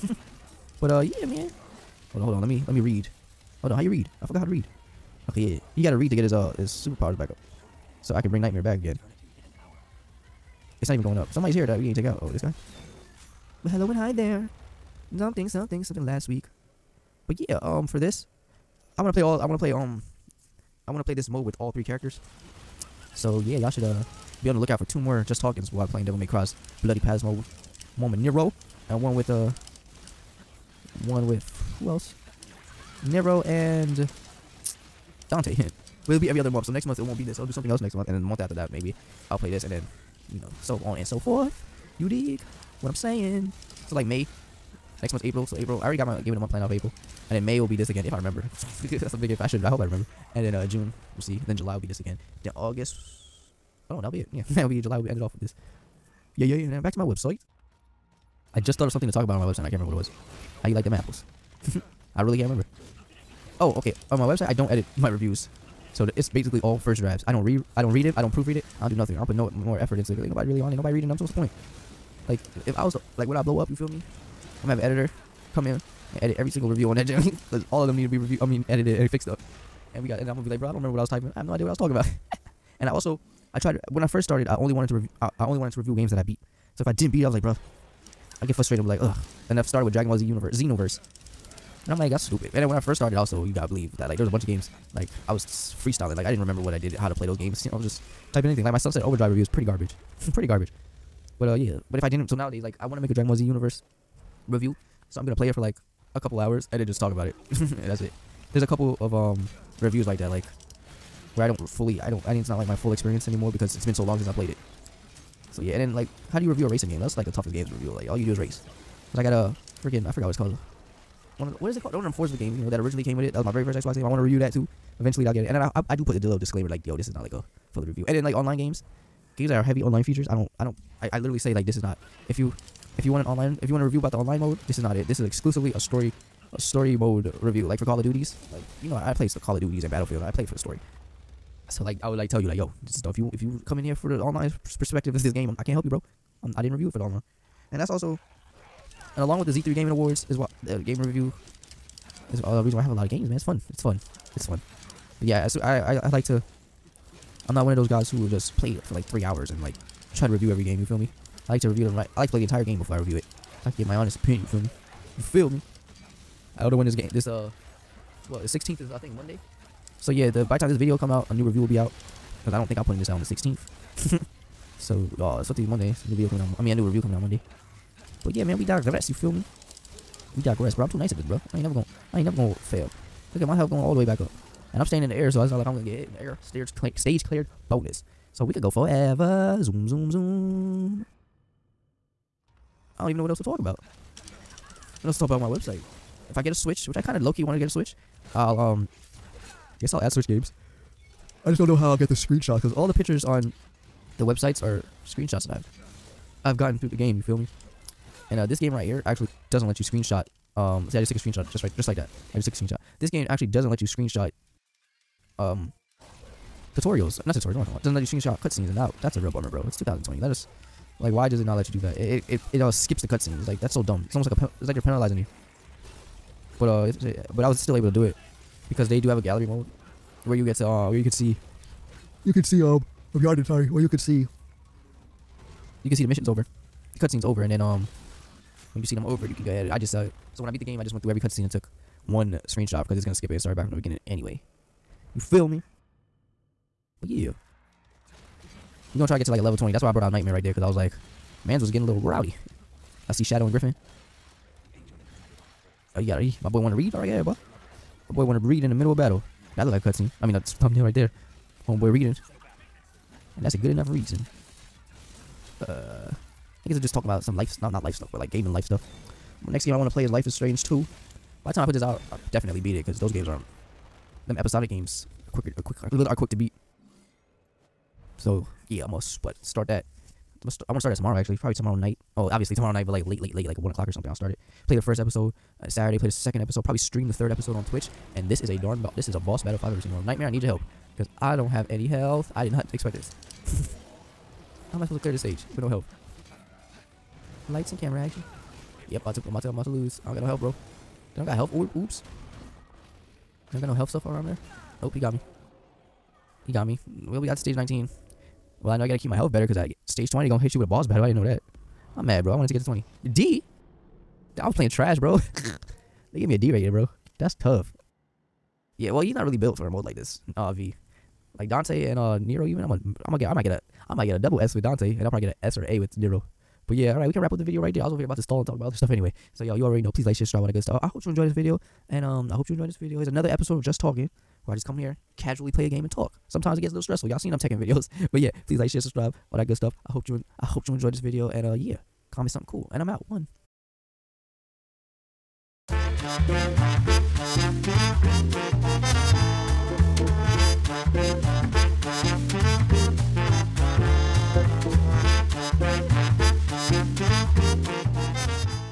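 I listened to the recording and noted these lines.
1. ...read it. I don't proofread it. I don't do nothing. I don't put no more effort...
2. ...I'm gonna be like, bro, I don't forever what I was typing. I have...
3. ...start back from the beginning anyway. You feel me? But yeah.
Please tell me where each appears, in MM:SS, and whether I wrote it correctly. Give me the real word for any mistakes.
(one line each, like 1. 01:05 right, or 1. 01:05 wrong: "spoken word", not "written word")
1. 01:07 right
2. 01:20 wrong: "remember", not "forever"
3. 04:03 right.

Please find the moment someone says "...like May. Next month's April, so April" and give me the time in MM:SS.
00:43.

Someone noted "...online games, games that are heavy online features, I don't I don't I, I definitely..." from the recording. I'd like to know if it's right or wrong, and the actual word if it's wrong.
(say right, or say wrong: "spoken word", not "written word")
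wrong: "literally", not "definitely".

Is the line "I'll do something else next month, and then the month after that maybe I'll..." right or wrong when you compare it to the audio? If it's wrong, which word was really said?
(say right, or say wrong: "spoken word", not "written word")
right.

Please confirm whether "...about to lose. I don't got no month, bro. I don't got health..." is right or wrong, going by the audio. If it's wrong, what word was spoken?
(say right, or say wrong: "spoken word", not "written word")
wrong: "health", not "month".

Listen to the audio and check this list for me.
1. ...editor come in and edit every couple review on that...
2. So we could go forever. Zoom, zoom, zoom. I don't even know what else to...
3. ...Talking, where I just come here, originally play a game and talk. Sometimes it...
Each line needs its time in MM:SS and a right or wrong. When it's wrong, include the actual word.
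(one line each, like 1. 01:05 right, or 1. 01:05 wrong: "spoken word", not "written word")
1. 01:14 wrong: "single", not "couple"
2. 03:08 right
3. 05:33 wrong: "casually", not "originally".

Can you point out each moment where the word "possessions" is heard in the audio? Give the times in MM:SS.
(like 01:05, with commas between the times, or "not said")
not said.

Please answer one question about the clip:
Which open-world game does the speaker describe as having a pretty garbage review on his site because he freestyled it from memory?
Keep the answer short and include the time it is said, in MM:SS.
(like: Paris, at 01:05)
Sunset Overdrive, at 01:38.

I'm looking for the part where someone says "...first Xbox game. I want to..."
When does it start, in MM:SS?
02:03.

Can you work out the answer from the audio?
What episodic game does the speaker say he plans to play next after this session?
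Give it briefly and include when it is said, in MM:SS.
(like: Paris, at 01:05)
Life is Strange 2, at 04:30.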